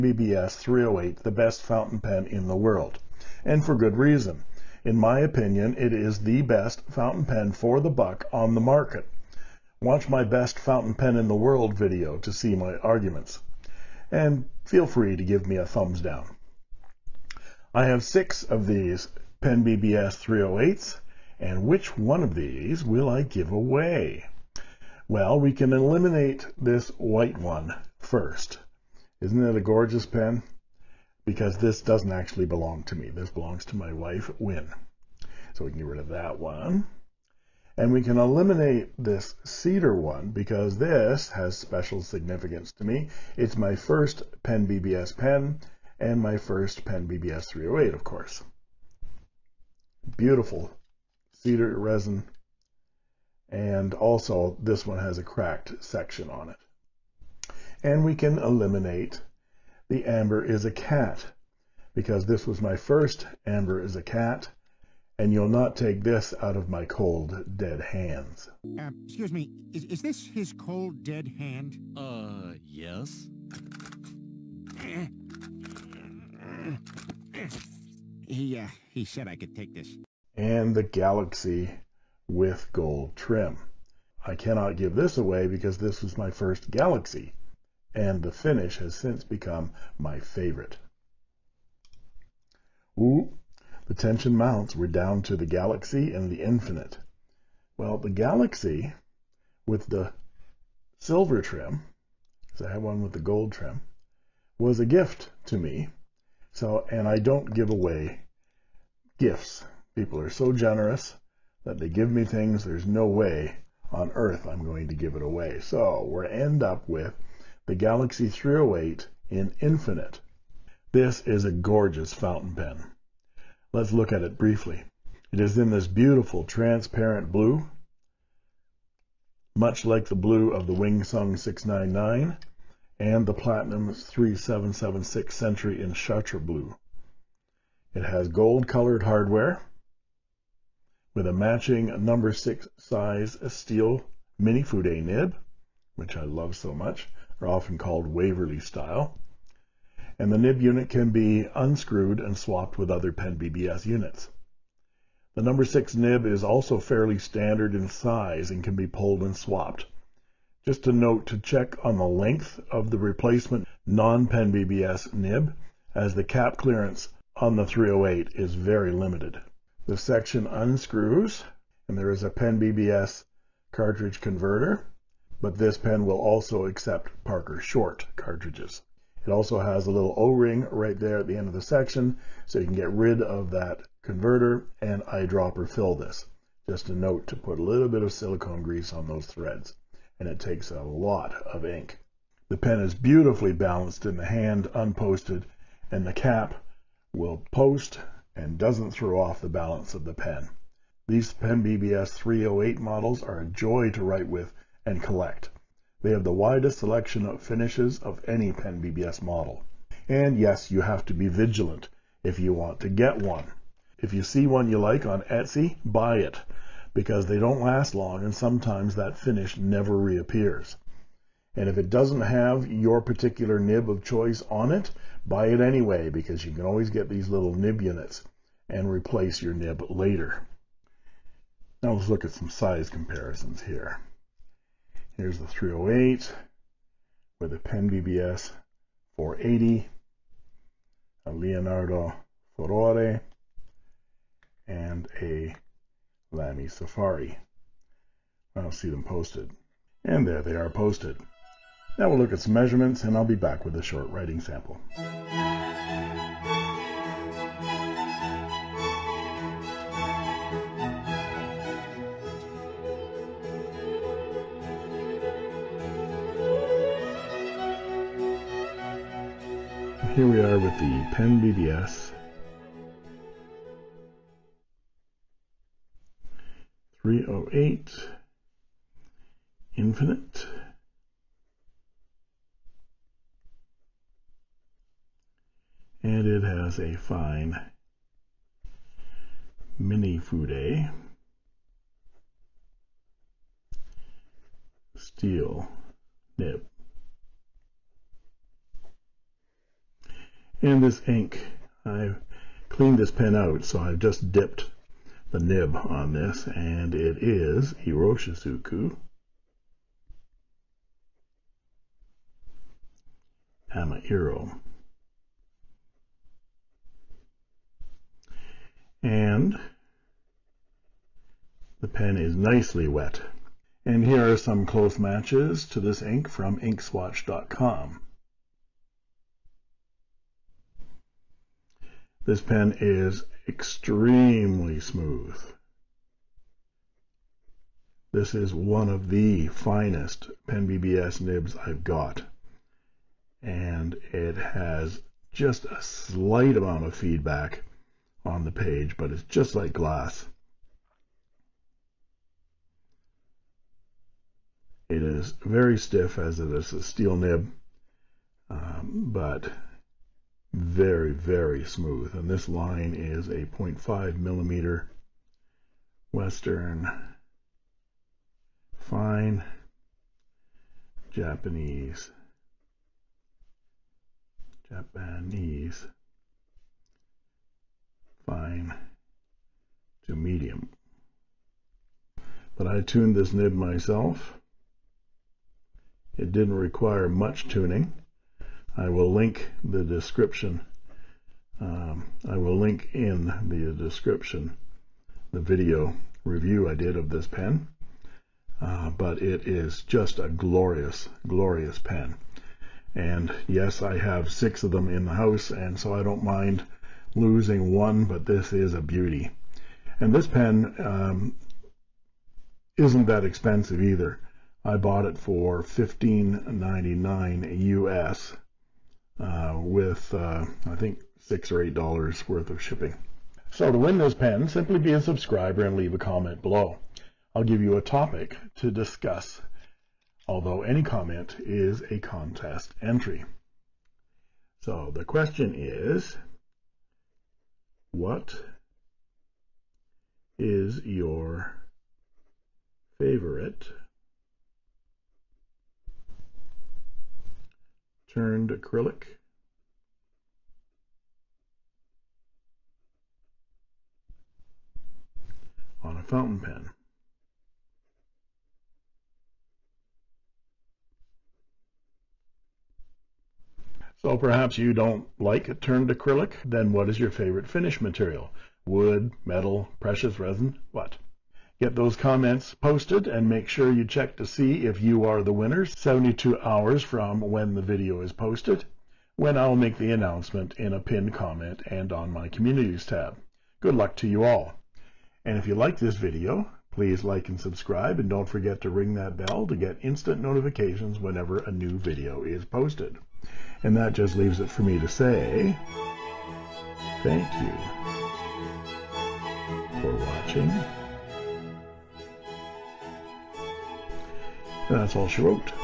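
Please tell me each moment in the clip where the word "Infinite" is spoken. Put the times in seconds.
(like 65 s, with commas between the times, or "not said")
96 s, 119 s, 279 s.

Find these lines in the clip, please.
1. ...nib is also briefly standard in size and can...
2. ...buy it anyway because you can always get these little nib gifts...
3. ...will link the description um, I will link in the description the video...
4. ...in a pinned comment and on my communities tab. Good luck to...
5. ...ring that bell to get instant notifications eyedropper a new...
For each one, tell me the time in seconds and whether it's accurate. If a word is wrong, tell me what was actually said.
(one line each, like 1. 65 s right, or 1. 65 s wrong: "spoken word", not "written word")
1. 155 s wrong: "fairly", not "briefly"
2. 225 s wrong: "units", not "gifts"
3. 388 s right
4. 480 s right
5. 488 s wrong: "whenever", not "eyedropper".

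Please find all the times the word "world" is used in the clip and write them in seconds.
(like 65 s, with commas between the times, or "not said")
2 s, 11 s.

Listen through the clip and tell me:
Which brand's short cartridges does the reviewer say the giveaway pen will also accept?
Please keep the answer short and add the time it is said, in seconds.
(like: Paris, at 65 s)
Parker, at 177 s.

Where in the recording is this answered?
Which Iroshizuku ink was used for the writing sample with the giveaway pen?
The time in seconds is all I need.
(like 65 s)
313 s.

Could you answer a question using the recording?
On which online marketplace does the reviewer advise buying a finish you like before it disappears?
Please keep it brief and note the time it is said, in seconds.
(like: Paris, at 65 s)
Etsy, at 215 s.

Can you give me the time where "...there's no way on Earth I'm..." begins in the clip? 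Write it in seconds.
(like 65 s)
112 s.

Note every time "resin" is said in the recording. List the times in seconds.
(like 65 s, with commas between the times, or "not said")
51 s, 470 s.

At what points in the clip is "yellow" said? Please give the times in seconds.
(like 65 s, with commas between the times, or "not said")
not said.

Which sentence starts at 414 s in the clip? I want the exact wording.
I bought it for $15.99 US uh, with, uh, I think, 6 or $8 worth of shipping.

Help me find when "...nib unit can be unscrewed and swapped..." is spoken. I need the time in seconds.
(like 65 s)
150 s.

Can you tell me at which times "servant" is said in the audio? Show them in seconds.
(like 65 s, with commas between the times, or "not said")
not said.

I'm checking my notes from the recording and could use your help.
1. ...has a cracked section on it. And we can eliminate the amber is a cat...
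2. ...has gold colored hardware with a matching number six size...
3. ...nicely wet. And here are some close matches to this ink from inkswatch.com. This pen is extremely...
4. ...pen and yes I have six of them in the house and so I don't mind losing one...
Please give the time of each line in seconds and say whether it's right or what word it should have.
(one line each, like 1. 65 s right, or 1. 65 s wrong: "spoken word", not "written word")
1. 54 s right
2. 138 s right
3. 322 s right
4. 401 s right.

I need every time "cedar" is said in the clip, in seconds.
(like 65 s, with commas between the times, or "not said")
39 s, 51 s.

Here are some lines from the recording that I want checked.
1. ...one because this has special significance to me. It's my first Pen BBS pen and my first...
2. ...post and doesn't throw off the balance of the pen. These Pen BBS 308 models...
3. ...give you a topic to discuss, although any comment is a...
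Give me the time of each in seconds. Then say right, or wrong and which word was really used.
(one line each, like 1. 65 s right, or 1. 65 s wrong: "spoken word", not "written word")
1. 39 s right
2. 197 s right
3. 427 s right.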